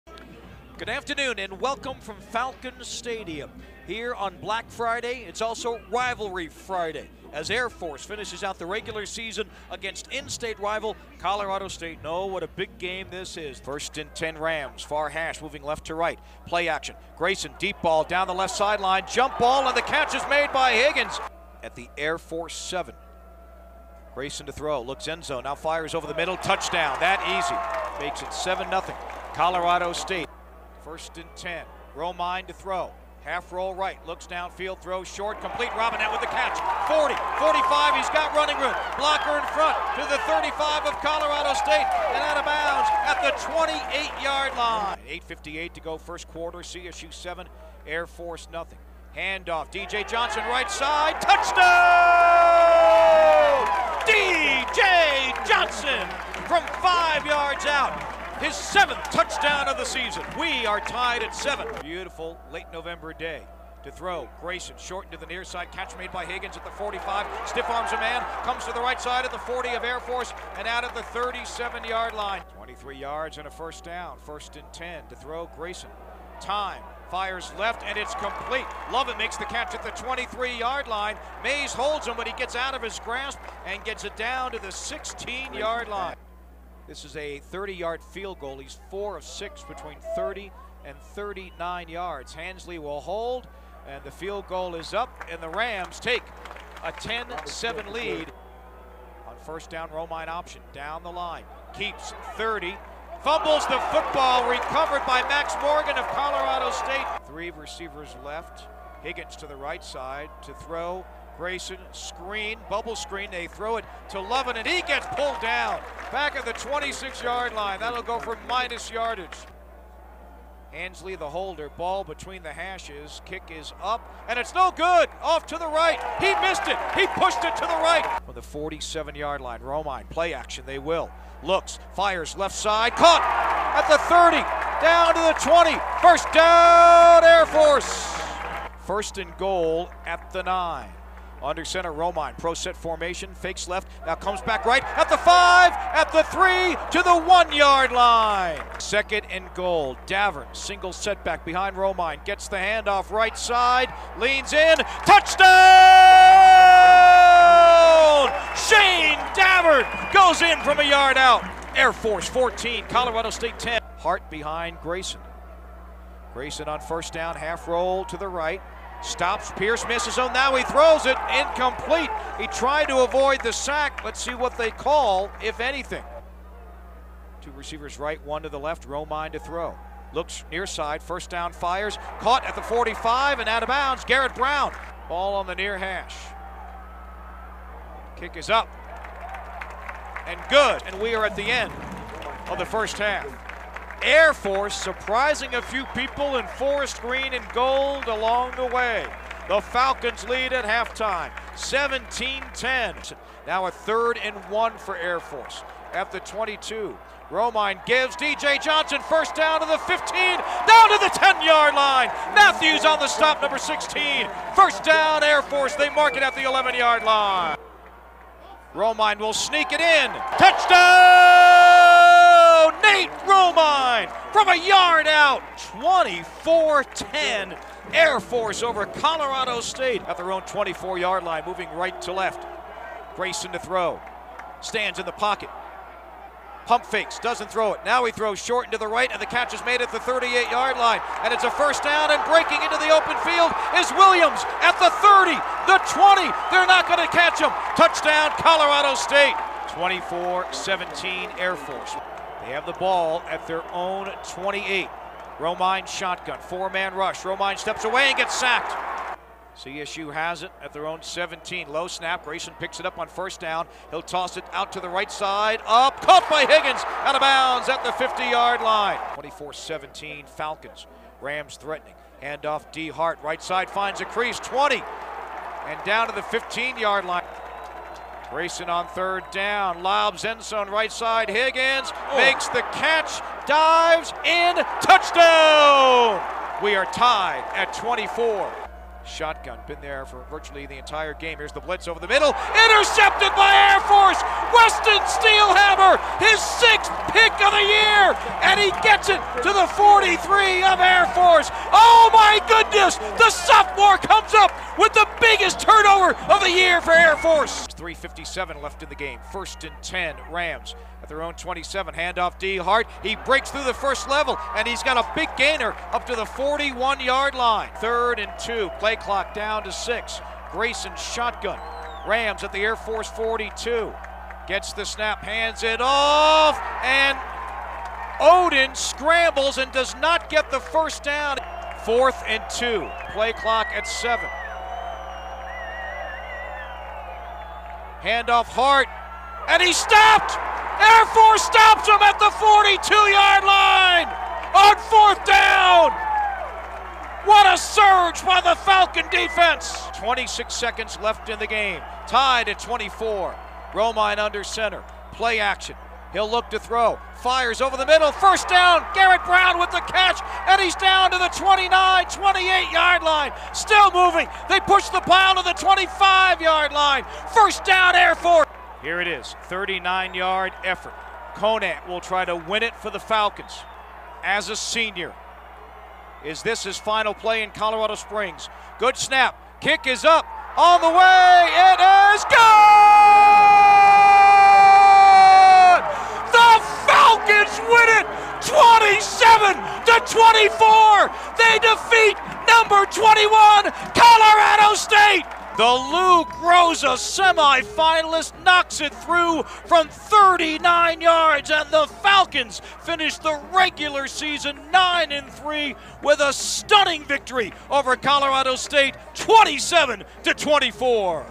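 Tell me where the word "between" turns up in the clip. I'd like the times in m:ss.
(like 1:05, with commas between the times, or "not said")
1:29, 2:02.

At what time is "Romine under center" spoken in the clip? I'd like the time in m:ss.
5:53.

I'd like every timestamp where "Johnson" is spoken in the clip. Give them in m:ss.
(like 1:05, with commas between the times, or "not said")
0:50, 0:55, 3:28.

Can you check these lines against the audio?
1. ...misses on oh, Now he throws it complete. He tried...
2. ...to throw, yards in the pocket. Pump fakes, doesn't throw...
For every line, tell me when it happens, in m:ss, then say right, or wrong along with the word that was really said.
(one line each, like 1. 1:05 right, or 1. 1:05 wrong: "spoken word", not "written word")
1. 2:49 wrong: "incomplete", not "complete"
2. 3:53 wrong: "stands", not "yards".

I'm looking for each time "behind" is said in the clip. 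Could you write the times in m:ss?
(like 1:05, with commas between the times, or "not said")
2:31, 2:44.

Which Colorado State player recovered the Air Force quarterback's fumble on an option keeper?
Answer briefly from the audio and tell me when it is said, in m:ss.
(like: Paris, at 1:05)
Max Morgan, at 1:44.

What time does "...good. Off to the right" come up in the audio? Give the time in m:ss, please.
2:04.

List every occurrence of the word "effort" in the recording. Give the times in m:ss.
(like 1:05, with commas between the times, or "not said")
6:10.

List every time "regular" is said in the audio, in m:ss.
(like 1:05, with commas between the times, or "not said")
0:08, 6:43.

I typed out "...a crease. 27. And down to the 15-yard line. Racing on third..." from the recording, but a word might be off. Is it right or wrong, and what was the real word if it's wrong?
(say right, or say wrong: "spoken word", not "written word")
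wrong: "20", not "27".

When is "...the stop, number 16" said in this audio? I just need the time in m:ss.
3:32.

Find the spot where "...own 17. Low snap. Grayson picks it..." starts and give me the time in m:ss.
4:20.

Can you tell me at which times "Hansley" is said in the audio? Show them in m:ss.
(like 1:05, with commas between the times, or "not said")
1:32, 2:00.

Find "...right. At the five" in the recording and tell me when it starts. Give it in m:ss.
2:24.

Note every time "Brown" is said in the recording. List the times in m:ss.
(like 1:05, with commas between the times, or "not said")
3:04, 5:59.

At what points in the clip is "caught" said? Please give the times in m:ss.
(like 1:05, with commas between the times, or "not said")
2:12, 3:02, 4:26.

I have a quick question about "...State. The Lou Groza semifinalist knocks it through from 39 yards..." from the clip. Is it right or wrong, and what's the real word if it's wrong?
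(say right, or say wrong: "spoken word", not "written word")
right.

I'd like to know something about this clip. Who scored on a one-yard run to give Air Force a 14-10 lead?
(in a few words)
Shayne Davern.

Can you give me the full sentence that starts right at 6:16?
Is this his final play in Colorado Springs?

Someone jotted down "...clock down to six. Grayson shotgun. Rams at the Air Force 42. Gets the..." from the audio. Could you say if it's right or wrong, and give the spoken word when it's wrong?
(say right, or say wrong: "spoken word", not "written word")
right.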